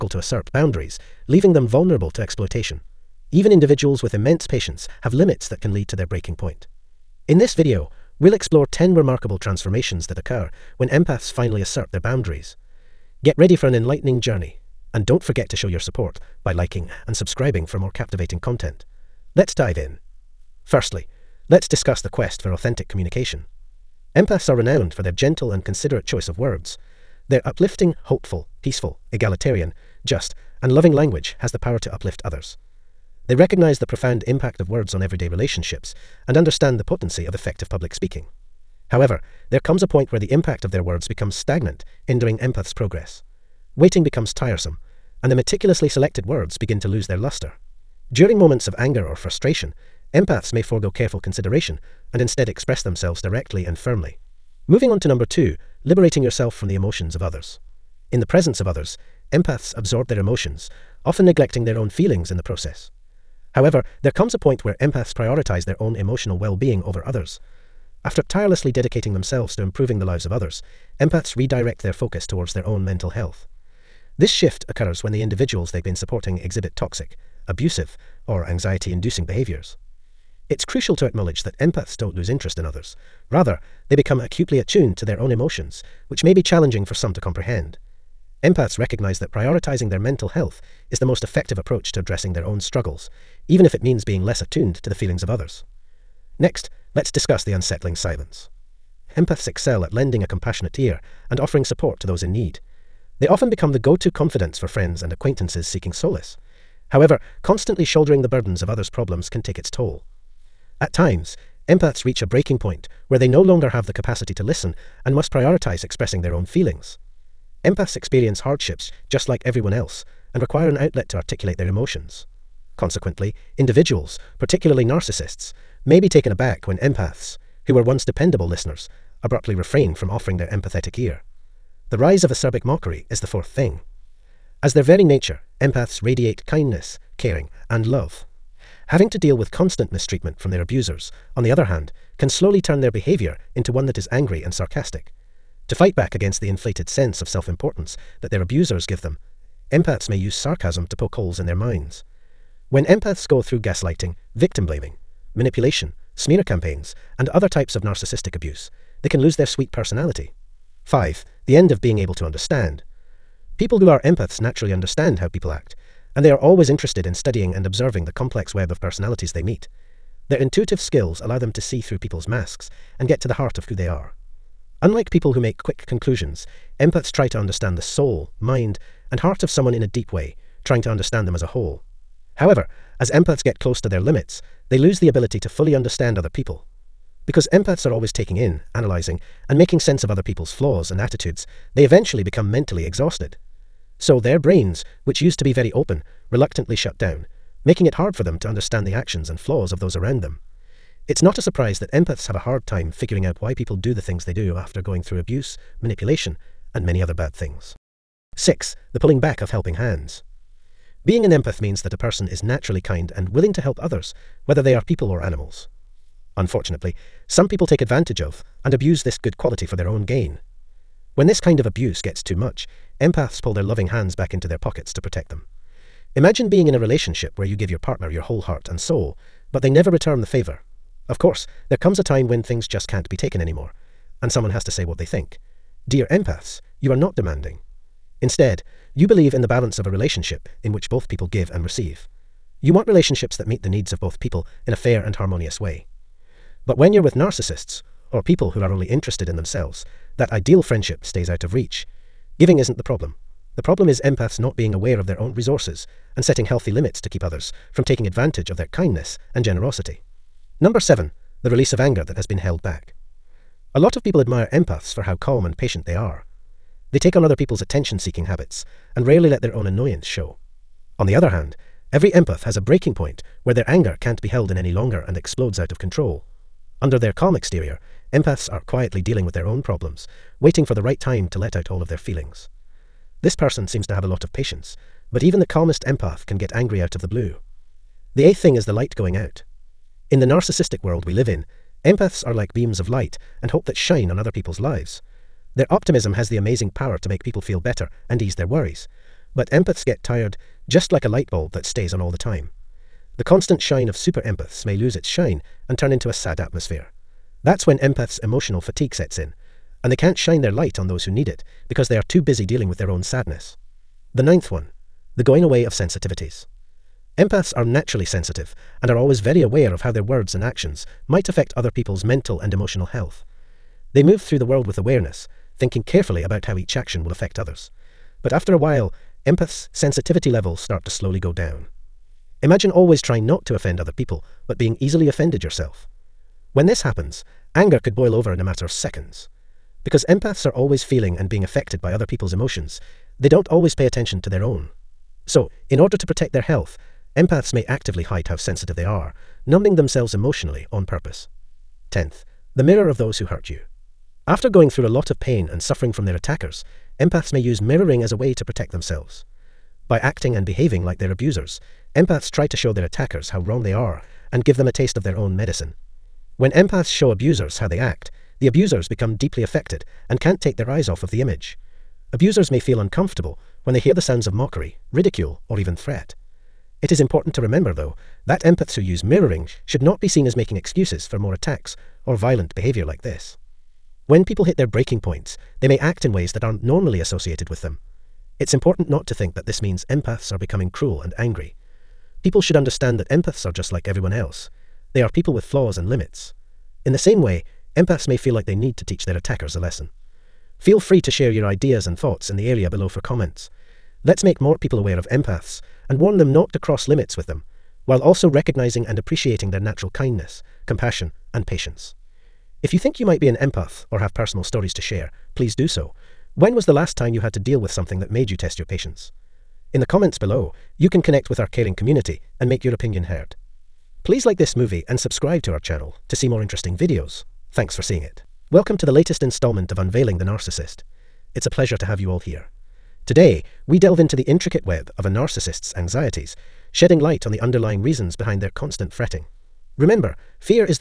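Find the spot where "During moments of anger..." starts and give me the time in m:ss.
0:48.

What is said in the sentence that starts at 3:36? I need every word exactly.
Unfortunately, some people take advantage of and abuse this good quality for their own gain.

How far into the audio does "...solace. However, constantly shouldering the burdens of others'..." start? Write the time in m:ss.
1:45.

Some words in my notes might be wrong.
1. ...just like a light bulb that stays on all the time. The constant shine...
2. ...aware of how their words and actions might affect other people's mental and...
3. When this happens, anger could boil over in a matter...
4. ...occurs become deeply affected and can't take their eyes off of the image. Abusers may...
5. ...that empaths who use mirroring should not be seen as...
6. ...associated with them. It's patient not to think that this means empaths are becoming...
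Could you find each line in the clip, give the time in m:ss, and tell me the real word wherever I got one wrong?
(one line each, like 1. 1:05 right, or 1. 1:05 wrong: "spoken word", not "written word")
1. 5:00 right
2. 5:19 right
3. 5:36 right
4. 6:08 wrong: "abusers", not "occurs"
5. 6:18 right
6. 6:26 wrong: "important", not "patient".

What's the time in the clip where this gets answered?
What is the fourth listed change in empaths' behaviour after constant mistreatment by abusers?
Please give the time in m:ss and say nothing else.
2:11.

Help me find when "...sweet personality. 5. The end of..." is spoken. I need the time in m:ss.
2:39.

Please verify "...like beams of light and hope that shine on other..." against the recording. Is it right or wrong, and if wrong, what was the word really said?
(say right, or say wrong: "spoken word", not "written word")
right.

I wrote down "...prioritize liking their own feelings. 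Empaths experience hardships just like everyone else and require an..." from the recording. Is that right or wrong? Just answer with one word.
wrong.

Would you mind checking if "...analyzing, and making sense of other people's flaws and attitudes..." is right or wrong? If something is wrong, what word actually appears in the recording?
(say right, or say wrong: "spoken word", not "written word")
right.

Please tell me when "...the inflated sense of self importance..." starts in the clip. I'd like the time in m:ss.
2:26.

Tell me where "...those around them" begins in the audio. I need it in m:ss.
3:19.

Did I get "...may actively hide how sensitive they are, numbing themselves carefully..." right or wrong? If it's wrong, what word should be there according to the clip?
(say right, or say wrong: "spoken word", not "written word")
wrong: "emotionally", not "carefully".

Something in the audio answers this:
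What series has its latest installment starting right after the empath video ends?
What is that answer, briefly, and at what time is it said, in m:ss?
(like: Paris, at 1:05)
Unveiling the Narcissist, at 7:09.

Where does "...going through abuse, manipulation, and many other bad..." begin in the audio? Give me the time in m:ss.
3:24.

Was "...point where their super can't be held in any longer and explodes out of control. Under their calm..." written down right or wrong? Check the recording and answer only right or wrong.
wrong.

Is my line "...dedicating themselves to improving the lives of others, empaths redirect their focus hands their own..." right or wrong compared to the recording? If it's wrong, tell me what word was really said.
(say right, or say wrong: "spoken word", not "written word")
wrong: "towards", not "hands".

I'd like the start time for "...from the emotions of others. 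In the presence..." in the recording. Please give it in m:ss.
0:56.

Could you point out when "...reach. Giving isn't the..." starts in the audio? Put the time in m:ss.
4:11.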